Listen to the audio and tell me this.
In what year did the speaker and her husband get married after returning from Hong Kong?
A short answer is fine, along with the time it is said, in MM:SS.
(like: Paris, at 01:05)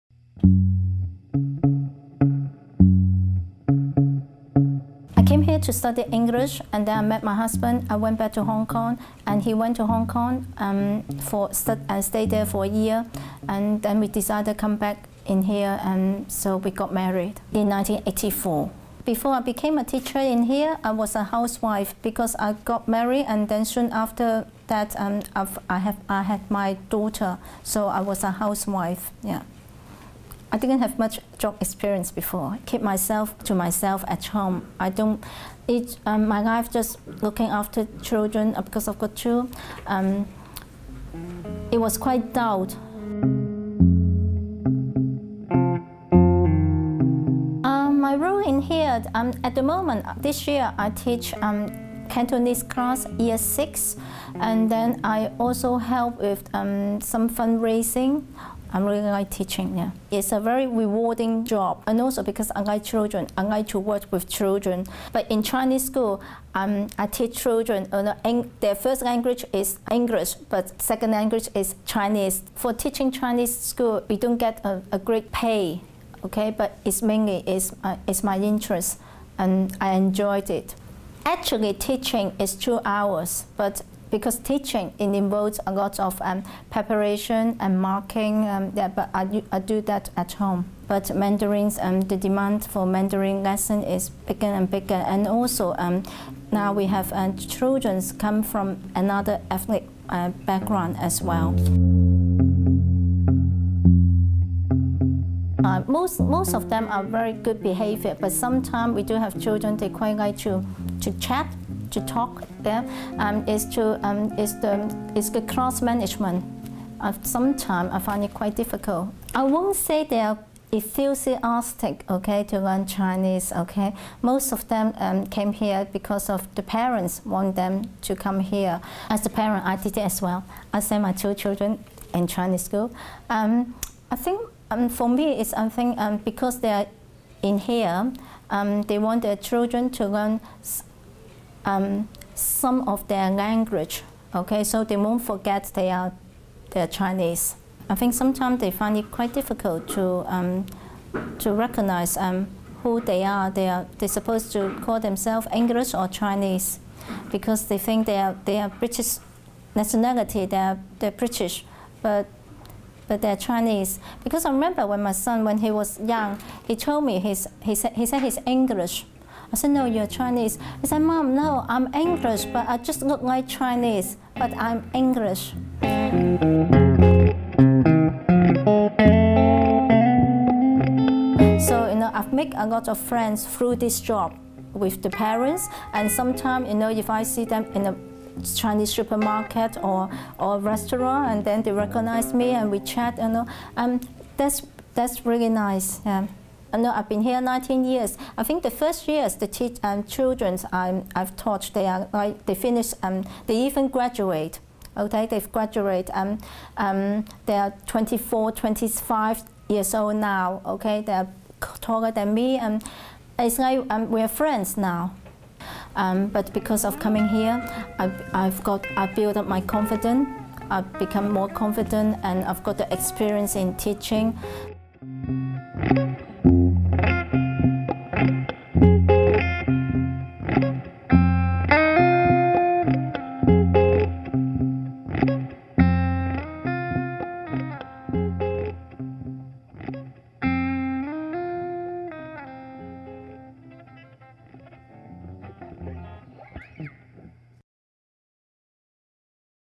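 1984, at 00:17.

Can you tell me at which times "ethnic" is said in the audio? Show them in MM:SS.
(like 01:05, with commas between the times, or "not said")
01:39.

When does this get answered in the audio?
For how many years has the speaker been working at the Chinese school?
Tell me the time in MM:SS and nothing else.
03:17.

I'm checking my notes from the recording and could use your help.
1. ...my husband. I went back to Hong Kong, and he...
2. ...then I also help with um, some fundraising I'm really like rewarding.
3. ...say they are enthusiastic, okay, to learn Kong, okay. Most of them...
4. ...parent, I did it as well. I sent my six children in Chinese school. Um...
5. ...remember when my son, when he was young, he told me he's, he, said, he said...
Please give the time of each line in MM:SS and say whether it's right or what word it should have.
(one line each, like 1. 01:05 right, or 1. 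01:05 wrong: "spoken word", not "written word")
1. 00:07 right
2. 00:54 wrong: "teaching", not "rewarding"
3. 01:59 wrong: "Chinese", not "Kong"
4. 02:09 wrong: "two", not "six"
5. 02:44 right.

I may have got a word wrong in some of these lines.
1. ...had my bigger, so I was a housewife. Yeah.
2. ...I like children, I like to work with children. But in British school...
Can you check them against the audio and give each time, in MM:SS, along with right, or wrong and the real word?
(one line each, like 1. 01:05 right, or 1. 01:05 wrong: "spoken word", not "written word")
1. 00:26 wrong: "daughter", not "bigger"
2. 01:02 wrong: "Chinese", not "British".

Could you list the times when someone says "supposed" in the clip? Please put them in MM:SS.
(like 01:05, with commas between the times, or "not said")
02:34.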